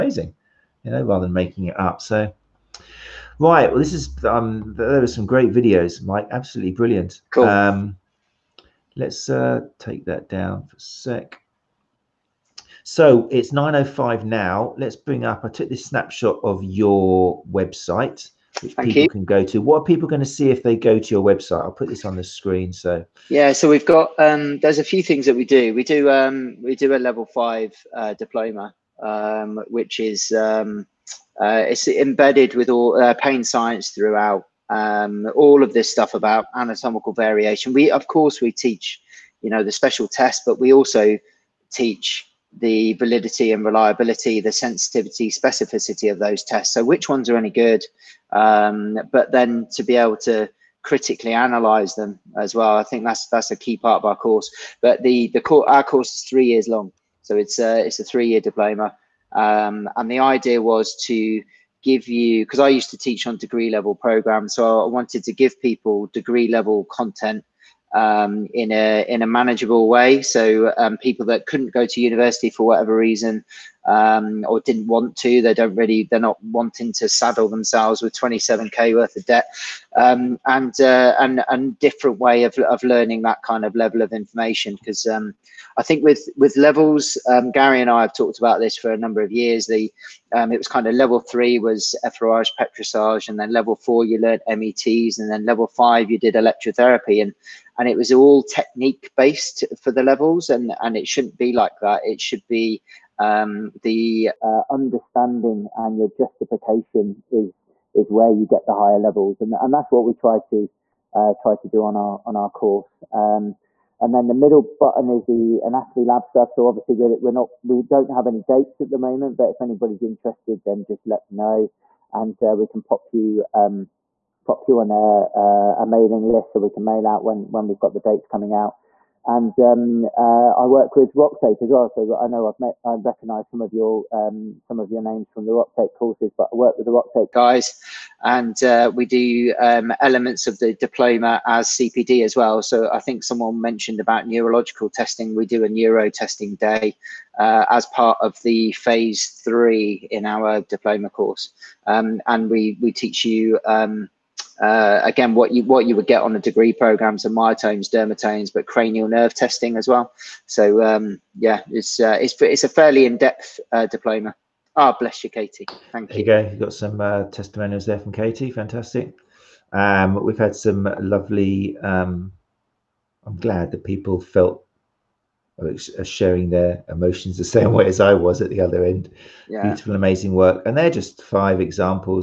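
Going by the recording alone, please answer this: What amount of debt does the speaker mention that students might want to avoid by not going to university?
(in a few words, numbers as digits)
27k.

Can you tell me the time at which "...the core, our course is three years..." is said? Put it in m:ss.
0:55.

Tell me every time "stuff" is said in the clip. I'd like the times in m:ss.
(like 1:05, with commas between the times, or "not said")
0:35, 1:56.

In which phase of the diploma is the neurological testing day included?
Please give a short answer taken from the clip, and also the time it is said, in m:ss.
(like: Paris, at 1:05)
Phase three, at 2:28.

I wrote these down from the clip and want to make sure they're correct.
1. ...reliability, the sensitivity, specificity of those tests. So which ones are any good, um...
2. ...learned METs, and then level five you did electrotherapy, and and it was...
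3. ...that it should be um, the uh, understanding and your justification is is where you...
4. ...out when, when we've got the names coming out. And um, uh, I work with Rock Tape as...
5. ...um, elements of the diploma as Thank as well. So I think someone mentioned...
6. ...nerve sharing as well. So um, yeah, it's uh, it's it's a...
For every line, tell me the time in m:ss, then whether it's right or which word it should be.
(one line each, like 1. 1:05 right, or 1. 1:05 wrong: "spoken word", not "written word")
1. 0:43 right
2. 1:34 right
3. 1:41 right
4. 2:07 wrong: "dates", not "names"
5. 2:19 wrong: "CPD", not "Thank"
6. 2:39 wrong: "testing", not "sharing".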